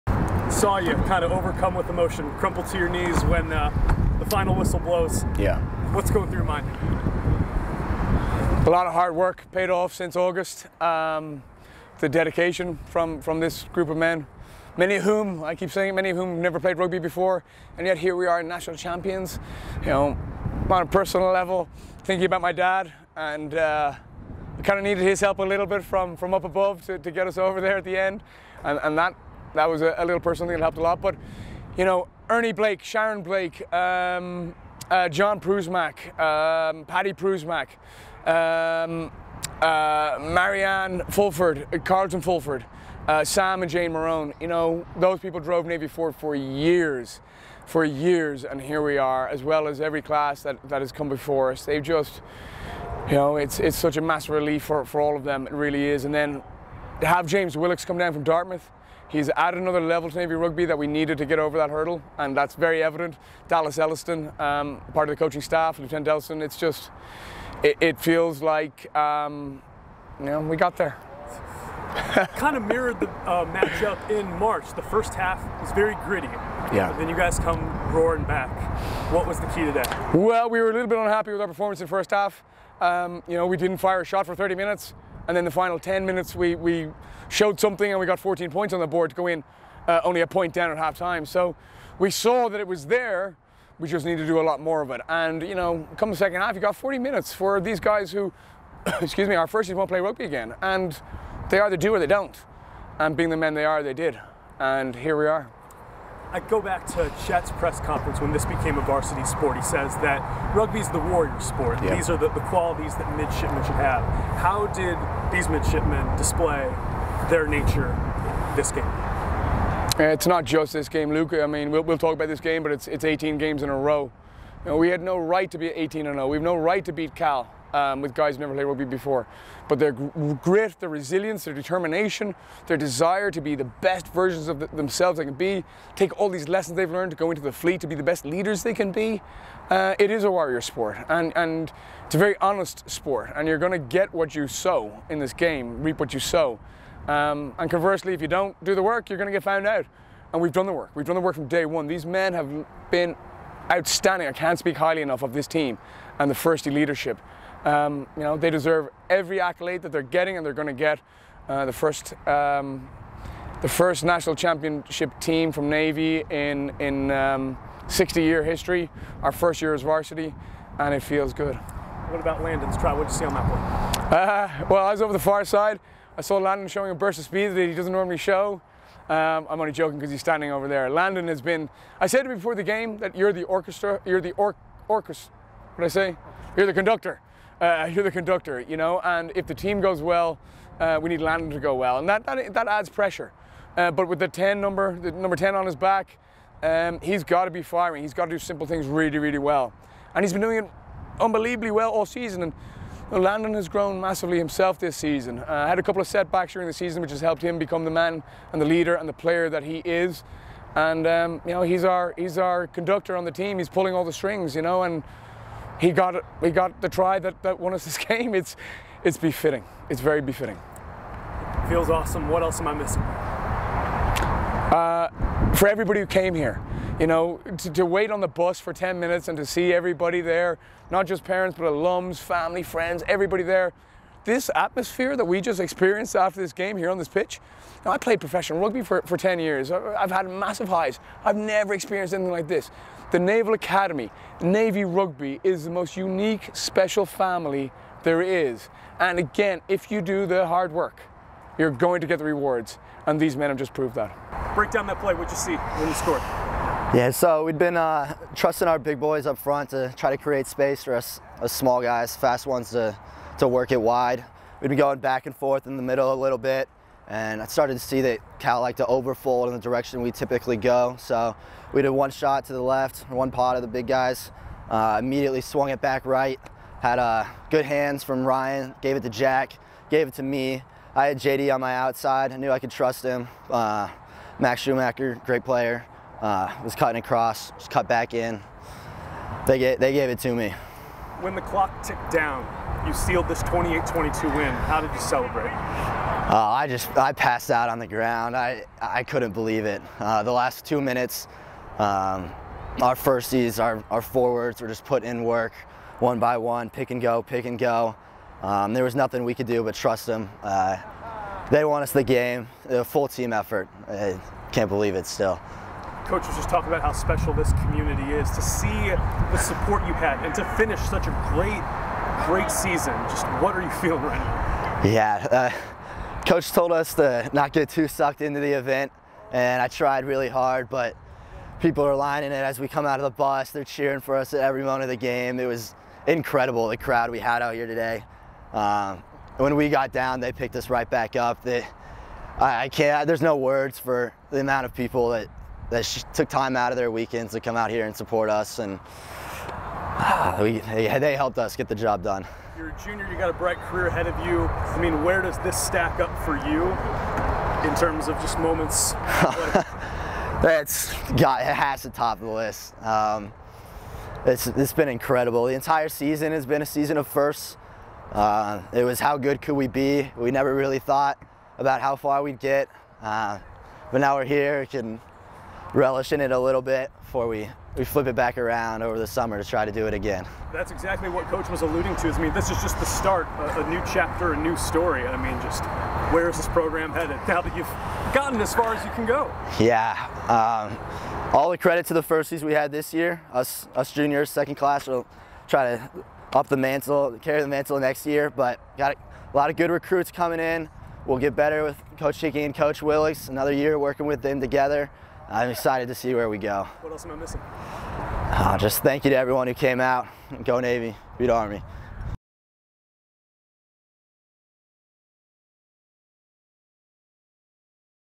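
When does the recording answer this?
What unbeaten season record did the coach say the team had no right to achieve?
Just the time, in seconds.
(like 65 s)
125 s.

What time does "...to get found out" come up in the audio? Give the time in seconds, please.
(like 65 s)
149 s.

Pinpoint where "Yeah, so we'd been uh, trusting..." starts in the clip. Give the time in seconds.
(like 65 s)
256 s.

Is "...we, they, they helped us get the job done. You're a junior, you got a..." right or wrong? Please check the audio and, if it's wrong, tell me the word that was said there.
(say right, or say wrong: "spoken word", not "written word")
right.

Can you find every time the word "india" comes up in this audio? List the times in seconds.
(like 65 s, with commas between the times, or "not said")
not said.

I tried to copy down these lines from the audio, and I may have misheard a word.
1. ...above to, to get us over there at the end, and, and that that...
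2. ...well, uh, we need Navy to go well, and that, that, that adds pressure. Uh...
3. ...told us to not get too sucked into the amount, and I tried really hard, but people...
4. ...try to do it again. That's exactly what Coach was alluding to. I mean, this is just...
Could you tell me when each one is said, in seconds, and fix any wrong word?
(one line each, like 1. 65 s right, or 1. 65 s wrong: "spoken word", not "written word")
1. 26 s right
2. 190 s wrong: "Landon", not "Navy"
3. 326 s wrong: "event", not "amount"
4. 379 s right.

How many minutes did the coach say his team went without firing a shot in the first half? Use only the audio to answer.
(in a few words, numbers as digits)
30.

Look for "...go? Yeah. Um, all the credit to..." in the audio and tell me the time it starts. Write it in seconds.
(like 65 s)
389 s.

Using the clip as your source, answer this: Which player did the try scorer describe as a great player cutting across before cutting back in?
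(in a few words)
Max Schumacher.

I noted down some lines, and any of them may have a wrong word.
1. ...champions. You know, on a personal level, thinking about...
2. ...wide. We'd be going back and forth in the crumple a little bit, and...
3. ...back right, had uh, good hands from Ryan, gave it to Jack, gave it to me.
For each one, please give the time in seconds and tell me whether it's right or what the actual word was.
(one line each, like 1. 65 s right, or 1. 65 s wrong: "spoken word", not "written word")
1. 18 s right
2. 263 s wrong: "middle", not "crumple"
3. 275 s right.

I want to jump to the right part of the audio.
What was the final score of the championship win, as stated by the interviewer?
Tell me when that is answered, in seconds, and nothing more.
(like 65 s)
293 s.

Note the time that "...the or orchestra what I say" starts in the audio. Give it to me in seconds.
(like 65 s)
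184 s.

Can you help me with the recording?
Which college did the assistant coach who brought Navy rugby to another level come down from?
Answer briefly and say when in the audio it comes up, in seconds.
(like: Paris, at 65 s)
Dartmouth, at 58 s.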